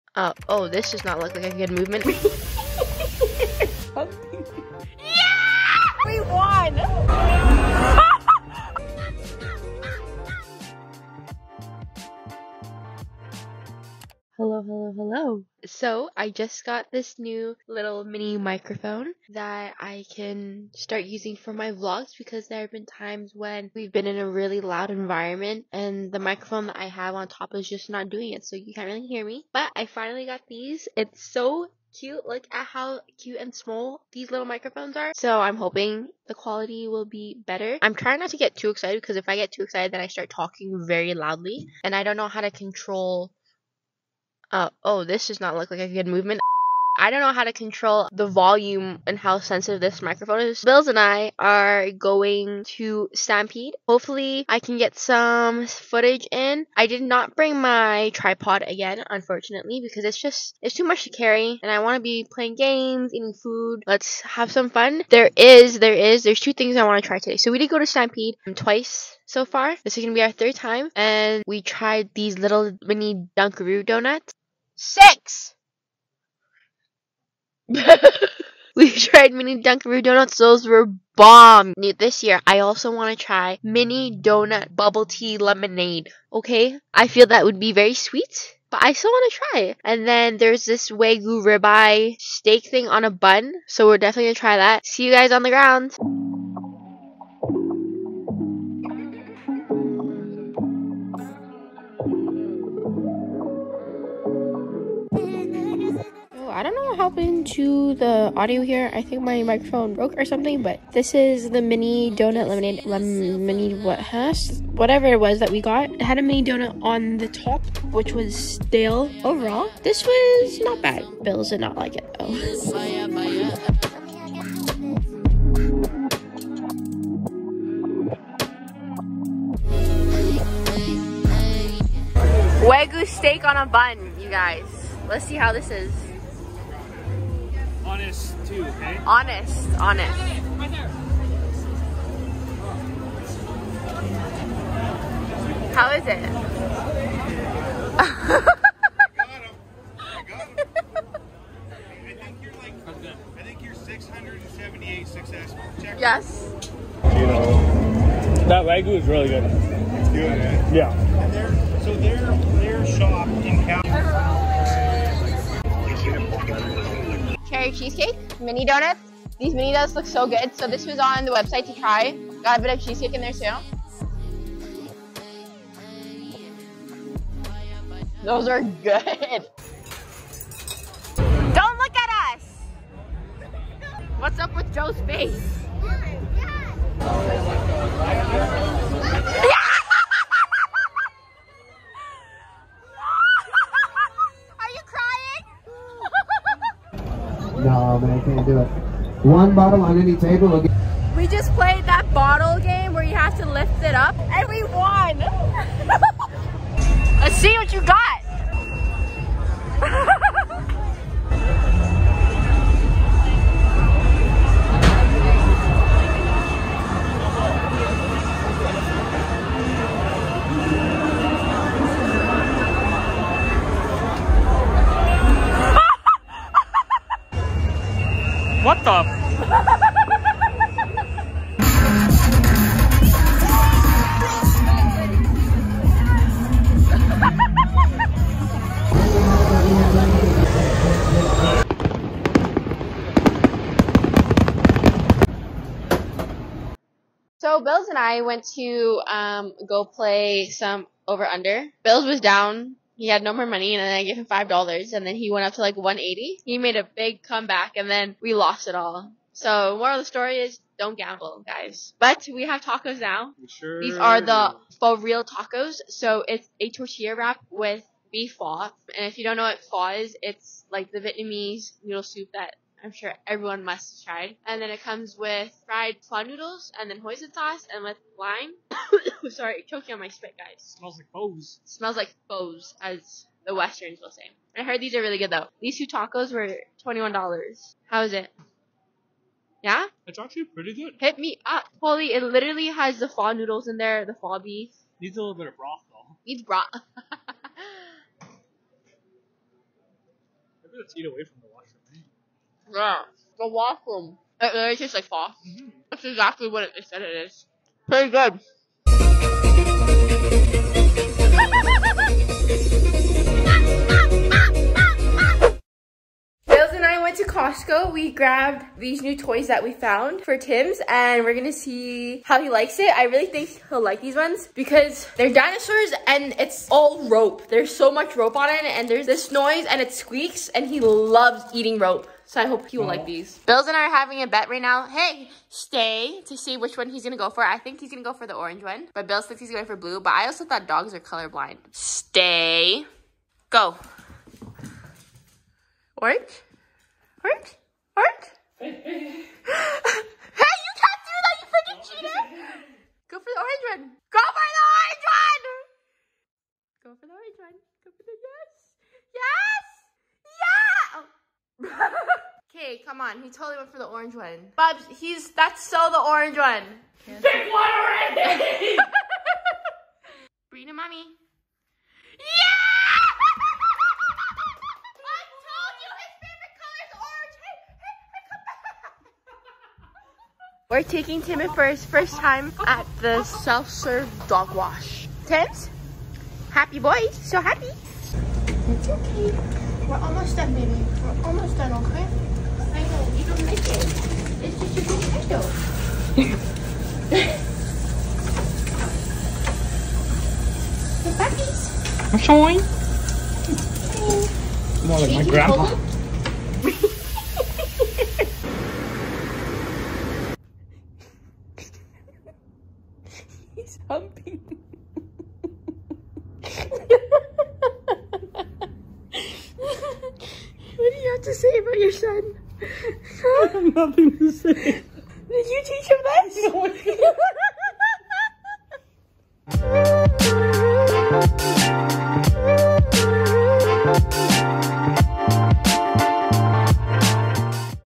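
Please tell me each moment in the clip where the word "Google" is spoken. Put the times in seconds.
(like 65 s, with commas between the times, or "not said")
not said.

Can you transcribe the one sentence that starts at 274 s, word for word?
And then it comes with fried prawn noodles, and then hoisin sauce, and with lime.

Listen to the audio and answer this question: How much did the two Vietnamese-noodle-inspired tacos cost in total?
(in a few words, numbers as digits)
$21.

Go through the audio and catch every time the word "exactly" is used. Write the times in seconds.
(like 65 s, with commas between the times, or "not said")
306 s.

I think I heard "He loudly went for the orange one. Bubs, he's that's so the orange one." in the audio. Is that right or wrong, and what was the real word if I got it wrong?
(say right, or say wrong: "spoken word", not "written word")
wrong: "totally", not "loudly".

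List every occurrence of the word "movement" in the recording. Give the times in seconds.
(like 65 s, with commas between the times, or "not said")
1 s, 46 s.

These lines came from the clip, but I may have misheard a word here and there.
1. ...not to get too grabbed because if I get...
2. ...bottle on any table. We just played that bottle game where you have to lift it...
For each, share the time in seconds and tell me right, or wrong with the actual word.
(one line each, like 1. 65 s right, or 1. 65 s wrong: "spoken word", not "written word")
1. 38 s wrong: "excited", not "grabbed"
2. 199 s right.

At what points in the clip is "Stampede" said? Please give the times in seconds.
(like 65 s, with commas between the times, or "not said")
53 s, 67 s.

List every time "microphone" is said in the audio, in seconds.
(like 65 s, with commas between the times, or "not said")
18 s, 26 s, 34 s, 50 s, 109 s.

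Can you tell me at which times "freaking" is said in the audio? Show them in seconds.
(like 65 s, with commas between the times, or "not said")
351 s.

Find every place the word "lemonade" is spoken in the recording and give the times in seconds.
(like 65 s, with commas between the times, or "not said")
85 s, 112 s.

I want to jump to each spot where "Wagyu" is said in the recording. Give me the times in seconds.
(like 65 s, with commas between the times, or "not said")
90 s, 132 s, 158 s.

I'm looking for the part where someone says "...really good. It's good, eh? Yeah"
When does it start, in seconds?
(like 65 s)
159 s.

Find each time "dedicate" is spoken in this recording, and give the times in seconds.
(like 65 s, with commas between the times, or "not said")
not said.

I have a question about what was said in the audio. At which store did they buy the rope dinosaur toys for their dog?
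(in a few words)
Costco.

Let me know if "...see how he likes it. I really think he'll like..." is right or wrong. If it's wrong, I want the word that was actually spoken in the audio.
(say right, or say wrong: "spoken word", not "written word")
right.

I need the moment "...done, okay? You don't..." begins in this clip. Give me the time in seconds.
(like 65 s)
391 s.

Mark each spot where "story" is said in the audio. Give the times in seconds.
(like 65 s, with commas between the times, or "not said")
260 s.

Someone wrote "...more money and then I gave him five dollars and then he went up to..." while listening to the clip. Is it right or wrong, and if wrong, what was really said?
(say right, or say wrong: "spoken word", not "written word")
right.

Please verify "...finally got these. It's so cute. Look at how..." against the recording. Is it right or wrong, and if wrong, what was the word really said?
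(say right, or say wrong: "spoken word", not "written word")
right.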